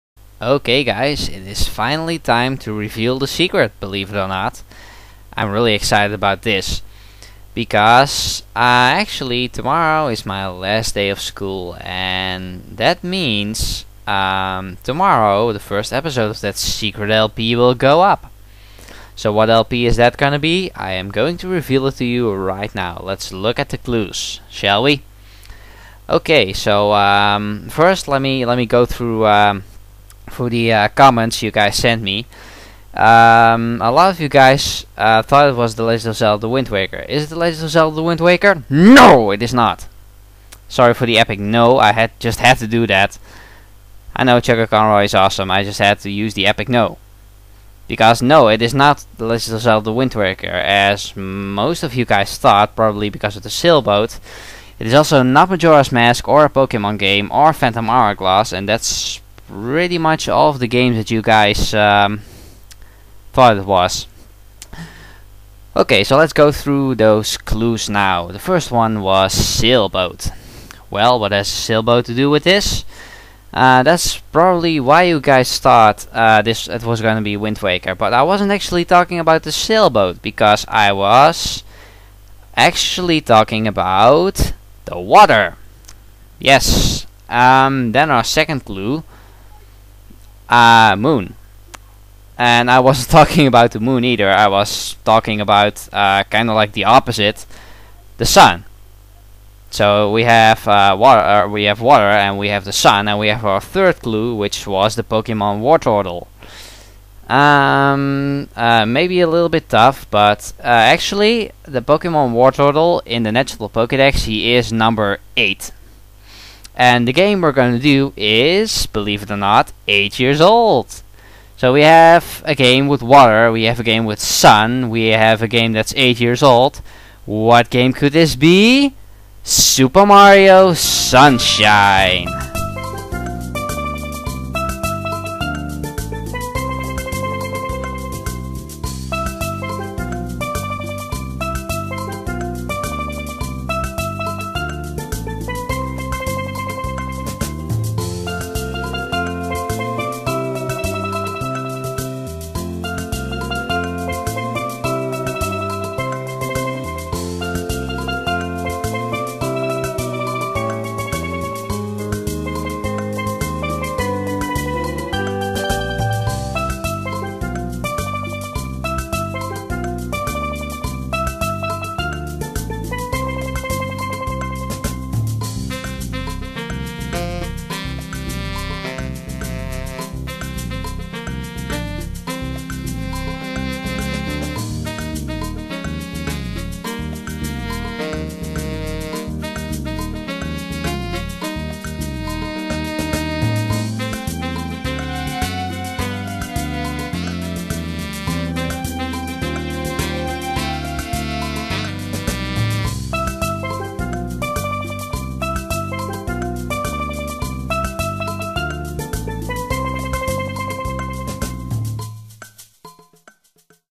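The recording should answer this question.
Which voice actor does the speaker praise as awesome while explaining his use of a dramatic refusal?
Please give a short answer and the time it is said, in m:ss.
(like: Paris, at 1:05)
Chuck Conroy, at 0:44.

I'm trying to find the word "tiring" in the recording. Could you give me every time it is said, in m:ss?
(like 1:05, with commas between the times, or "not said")
not said.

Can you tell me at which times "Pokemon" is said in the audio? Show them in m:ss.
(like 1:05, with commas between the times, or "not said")
0:56, 1:45, 1:51.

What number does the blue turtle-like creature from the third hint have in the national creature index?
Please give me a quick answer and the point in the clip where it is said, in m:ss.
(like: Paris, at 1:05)
8, at 1:54.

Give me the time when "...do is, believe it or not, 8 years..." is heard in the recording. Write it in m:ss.
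1:57.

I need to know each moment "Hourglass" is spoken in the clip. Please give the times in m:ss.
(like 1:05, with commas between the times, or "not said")
0:57.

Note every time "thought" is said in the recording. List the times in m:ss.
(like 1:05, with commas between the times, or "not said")
0:35, 0:52, 1:03, 1:15.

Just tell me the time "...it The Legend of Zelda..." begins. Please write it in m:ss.
0:37.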